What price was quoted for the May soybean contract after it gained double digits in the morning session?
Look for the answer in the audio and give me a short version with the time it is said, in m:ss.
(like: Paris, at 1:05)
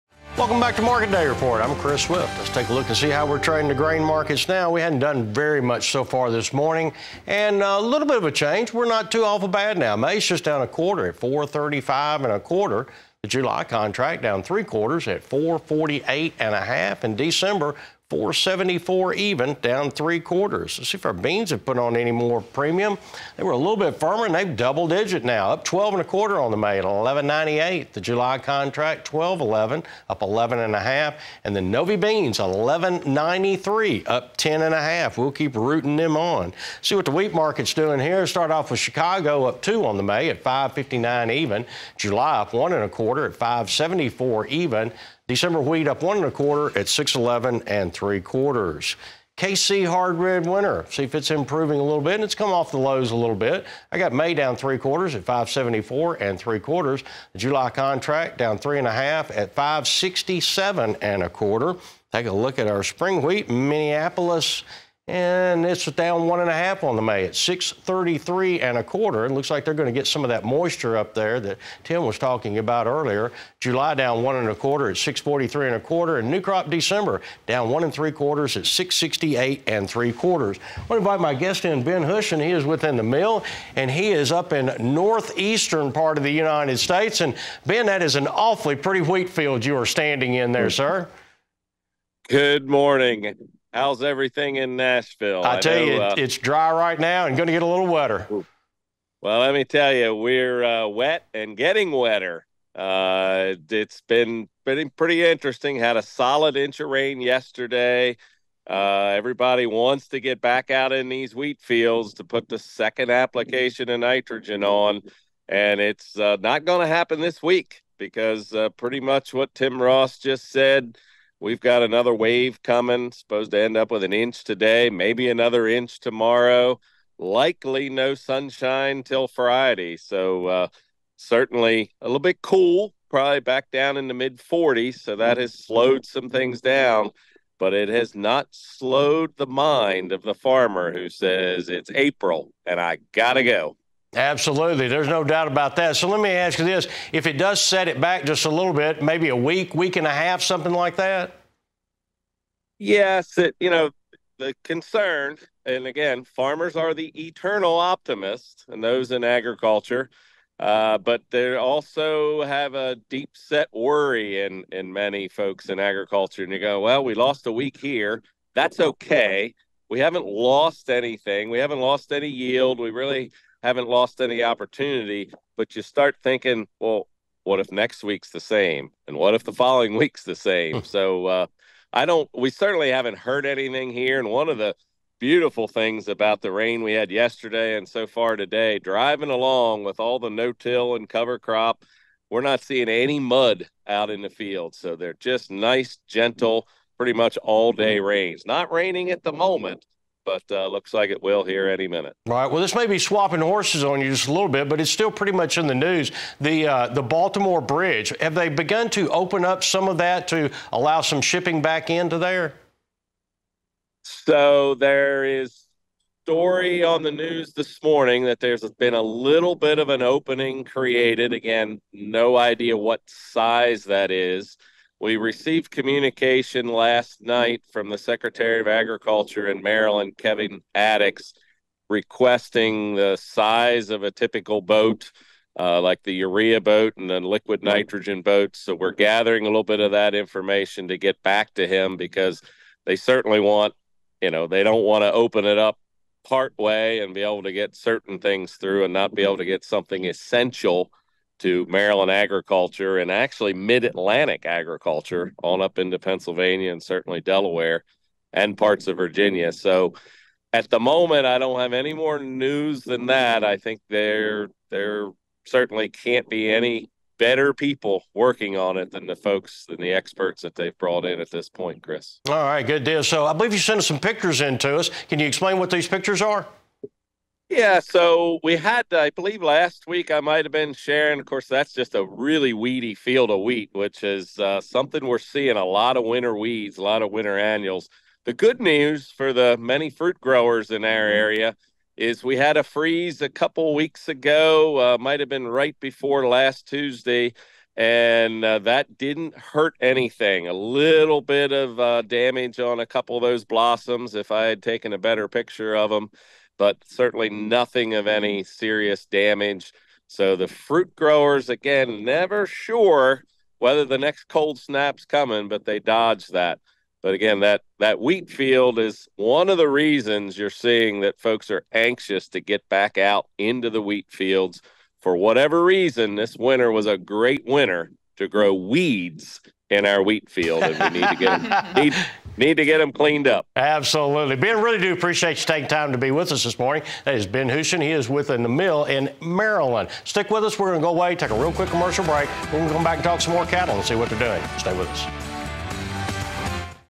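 11.98, at 0:26.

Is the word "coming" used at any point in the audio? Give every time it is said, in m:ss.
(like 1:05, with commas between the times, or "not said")
2:02, 5:15.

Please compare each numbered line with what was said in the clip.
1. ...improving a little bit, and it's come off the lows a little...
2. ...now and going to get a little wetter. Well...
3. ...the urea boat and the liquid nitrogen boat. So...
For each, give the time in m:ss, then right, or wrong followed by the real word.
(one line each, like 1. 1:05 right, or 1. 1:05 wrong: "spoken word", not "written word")
1. 0:51 right
2. 1:36 right
3. 3:56 right.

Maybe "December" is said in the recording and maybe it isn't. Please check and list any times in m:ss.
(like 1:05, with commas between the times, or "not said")
0:17, 0:45, 1:16.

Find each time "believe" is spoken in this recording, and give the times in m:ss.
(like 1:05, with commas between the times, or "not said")
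4:33, 4:39.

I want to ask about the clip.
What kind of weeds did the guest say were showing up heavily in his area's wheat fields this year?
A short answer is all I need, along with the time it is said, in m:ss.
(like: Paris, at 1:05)
Winter annuals, at 4:47.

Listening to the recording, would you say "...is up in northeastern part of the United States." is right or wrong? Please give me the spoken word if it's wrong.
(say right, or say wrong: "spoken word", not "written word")
right.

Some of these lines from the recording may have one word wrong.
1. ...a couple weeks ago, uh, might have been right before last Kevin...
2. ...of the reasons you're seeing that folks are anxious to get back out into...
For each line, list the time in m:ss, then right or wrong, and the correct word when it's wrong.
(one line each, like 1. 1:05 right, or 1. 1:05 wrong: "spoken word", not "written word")
1. 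4:53 wrong: "Tuesday", not "Kevin"
2. 5:19 right.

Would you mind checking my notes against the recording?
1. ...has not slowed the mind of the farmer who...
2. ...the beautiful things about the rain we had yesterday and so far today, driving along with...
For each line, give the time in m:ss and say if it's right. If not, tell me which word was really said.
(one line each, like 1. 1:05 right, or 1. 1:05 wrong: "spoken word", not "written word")
1. 2:17 right
2. 3:04 right.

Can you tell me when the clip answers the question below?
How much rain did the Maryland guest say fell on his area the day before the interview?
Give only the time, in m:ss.
1:45.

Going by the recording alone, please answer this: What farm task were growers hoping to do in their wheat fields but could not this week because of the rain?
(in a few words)
Second application of nitrogen.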